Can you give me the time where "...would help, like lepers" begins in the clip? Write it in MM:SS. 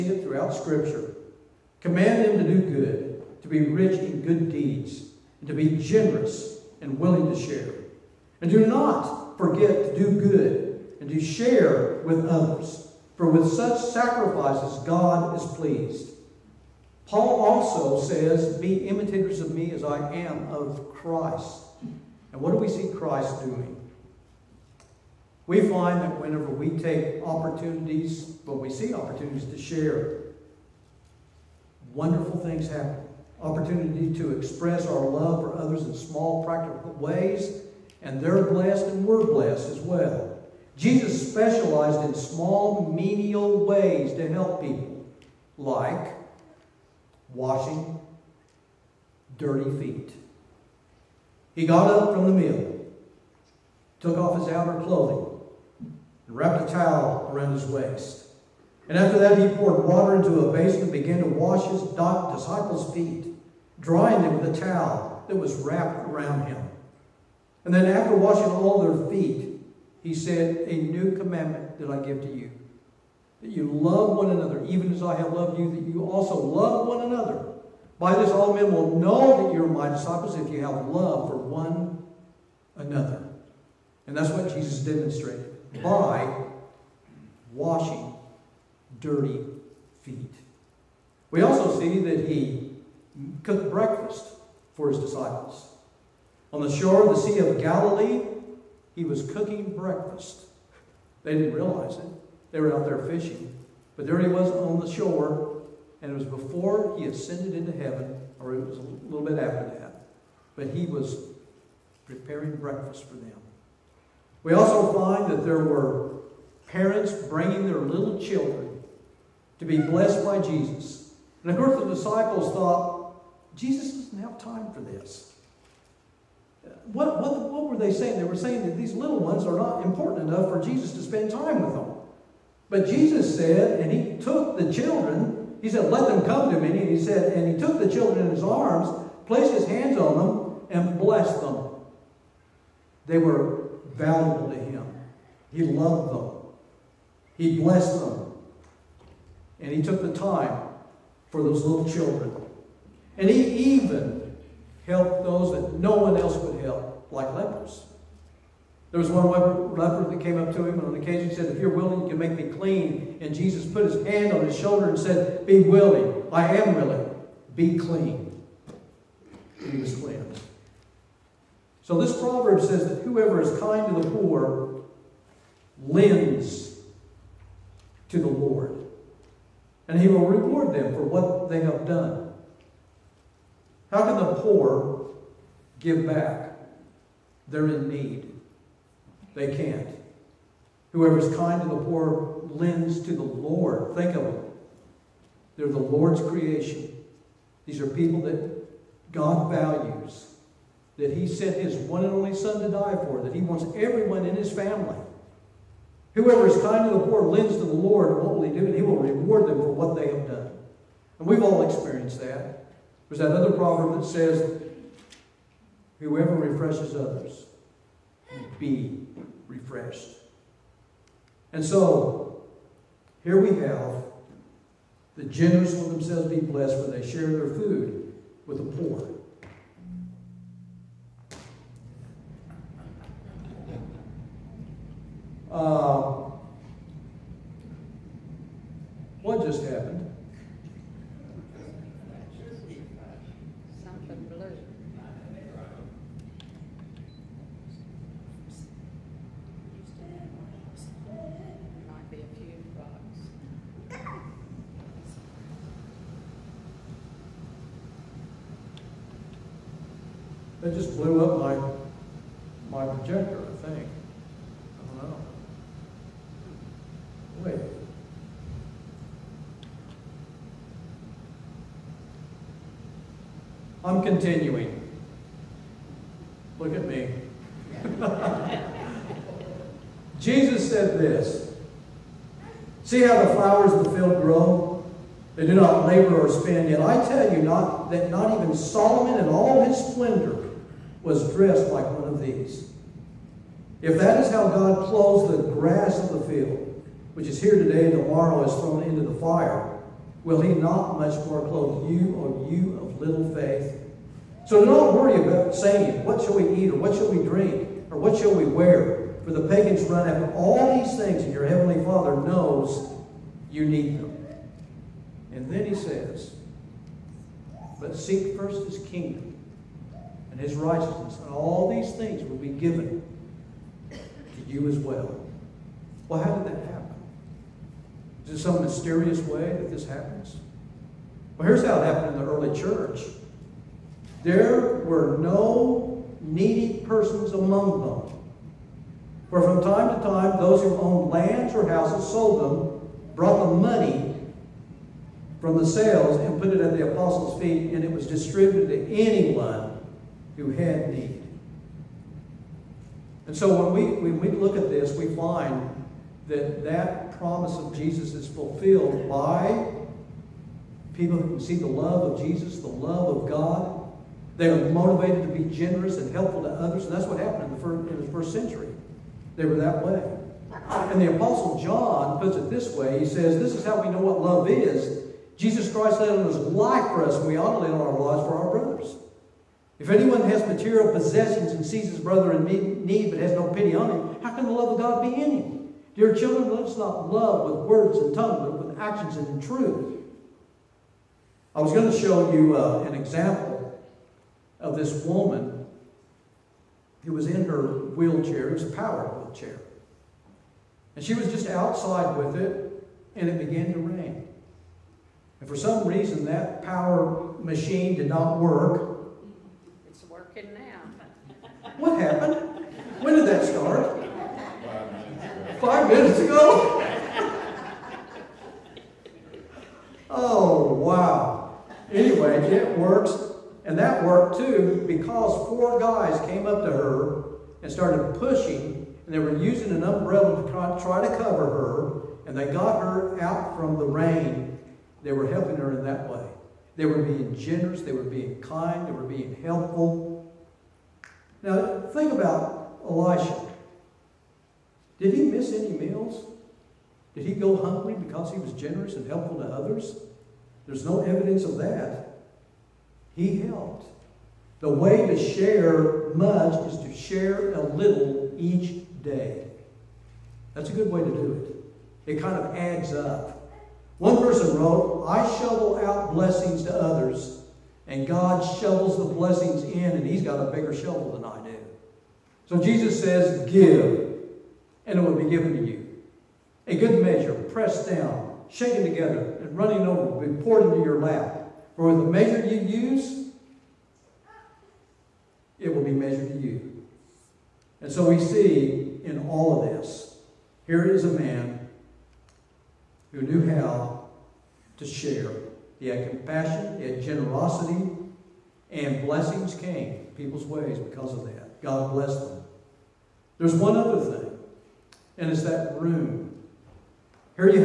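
02:36.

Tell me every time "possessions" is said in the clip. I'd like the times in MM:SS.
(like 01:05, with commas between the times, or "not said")
06:20.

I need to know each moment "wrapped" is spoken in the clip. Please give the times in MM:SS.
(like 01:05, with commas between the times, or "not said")
00:56, 01:05.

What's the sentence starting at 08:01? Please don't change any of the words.
For the measure you use, it will be measured to you.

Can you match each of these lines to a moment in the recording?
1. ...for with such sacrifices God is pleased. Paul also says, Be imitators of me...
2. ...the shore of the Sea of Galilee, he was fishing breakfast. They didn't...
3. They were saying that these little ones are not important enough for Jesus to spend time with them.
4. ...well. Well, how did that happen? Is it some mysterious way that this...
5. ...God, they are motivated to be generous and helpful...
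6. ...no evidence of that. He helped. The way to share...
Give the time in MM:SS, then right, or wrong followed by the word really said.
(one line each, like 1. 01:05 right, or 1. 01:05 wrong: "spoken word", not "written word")
1. 00:13 right
2. 01:36 wrong: "cooking", not "fishing"
3. 02:08 right
4. 05:24 right
5. 06:03 right
6. 07:30 right.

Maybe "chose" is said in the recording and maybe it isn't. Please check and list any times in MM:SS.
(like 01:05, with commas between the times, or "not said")
not said.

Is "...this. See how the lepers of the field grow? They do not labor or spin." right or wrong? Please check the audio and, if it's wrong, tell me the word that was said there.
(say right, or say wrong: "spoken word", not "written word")
wrong: "flowers", not "lepers".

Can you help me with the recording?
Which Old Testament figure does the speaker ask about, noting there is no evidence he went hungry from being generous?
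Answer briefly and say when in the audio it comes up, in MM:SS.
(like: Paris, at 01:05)
Elisha, at 07:22.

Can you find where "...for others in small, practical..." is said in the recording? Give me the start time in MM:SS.
00:35.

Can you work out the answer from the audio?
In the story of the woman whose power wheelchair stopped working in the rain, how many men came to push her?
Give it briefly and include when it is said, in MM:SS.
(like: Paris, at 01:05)
4, at 07:05.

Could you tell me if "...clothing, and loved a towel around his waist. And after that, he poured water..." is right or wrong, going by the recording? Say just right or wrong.
wrong.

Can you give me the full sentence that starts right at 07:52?
So Jesus says, Give, and it will be given to you.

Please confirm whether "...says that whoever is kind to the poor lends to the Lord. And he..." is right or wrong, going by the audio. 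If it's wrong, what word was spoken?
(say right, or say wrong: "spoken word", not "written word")
right.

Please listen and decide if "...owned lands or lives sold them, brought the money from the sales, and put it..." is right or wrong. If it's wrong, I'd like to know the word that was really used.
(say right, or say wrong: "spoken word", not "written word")
wrong: "houses", not "lives".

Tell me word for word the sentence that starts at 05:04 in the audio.
So don't worry about saying, what shall we eat or what shall we drink or what shall we wear?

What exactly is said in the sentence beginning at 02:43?
And Jesus put his hand on his shoulder and said, Be willing.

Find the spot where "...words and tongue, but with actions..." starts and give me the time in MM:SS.
06:27.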